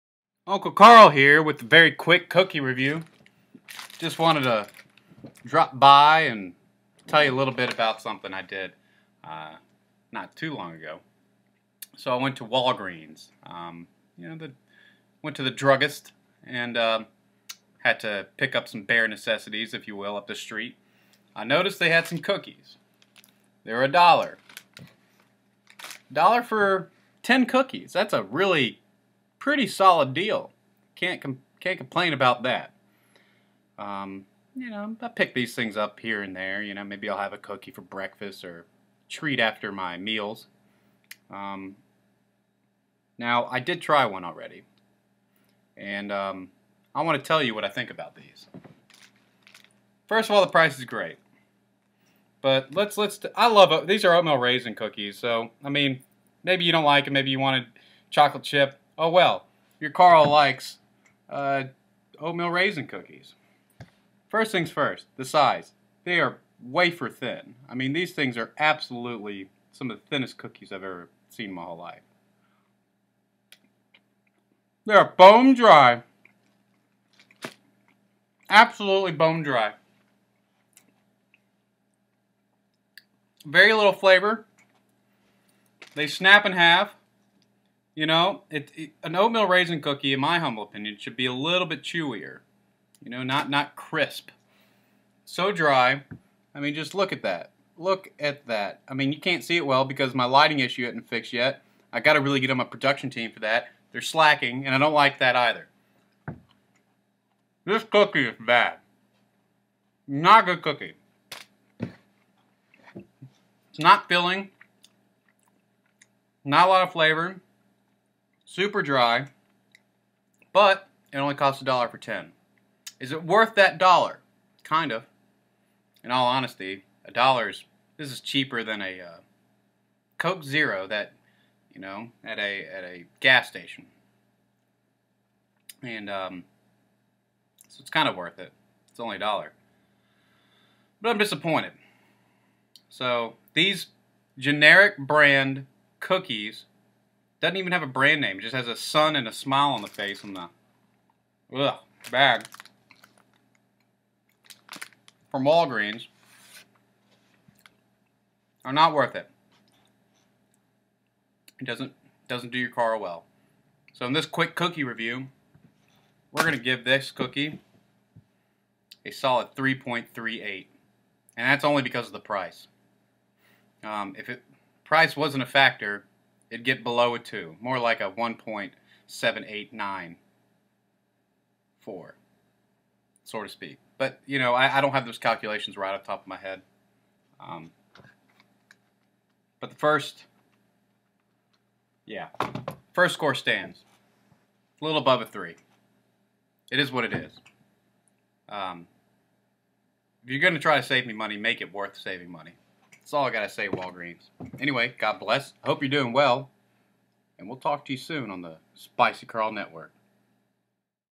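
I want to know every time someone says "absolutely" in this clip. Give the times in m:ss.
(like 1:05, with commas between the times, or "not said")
1:08, 1:18.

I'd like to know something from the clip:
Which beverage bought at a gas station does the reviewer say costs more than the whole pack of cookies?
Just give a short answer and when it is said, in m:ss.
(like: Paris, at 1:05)
Coke Zero, at 2:10.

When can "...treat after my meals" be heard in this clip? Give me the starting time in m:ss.
0:39.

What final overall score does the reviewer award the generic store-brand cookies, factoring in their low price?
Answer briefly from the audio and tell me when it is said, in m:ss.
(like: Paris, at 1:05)
3.38, at 2:49.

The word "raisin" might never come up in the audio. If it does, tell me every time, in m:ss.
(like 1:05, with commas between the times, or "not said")
0:54, 1:02, 1:29.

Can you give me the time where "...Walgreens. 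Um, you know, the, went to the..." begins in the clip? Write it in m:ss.
0:12.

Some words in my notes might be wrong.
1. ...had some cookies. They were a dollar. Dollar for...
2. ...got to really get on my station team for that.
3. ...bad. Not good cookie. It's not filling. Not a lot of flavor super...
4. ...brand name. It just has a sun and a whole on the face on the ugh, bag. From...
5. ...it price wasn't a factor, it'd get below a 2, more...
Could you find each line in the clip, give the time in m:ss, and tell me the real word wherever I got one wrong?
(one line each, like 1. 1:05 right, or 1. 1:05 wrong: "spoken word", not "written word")
1. 0:21 right
2. 1:41 wrong: "production", not "station"
3. 1:48 right
4. 2:27 wrong: "smile", not "whole"
5. 2:54 right.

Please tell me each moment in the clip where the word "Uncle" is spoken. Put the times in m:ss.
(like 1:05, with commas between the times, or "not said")
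0:00.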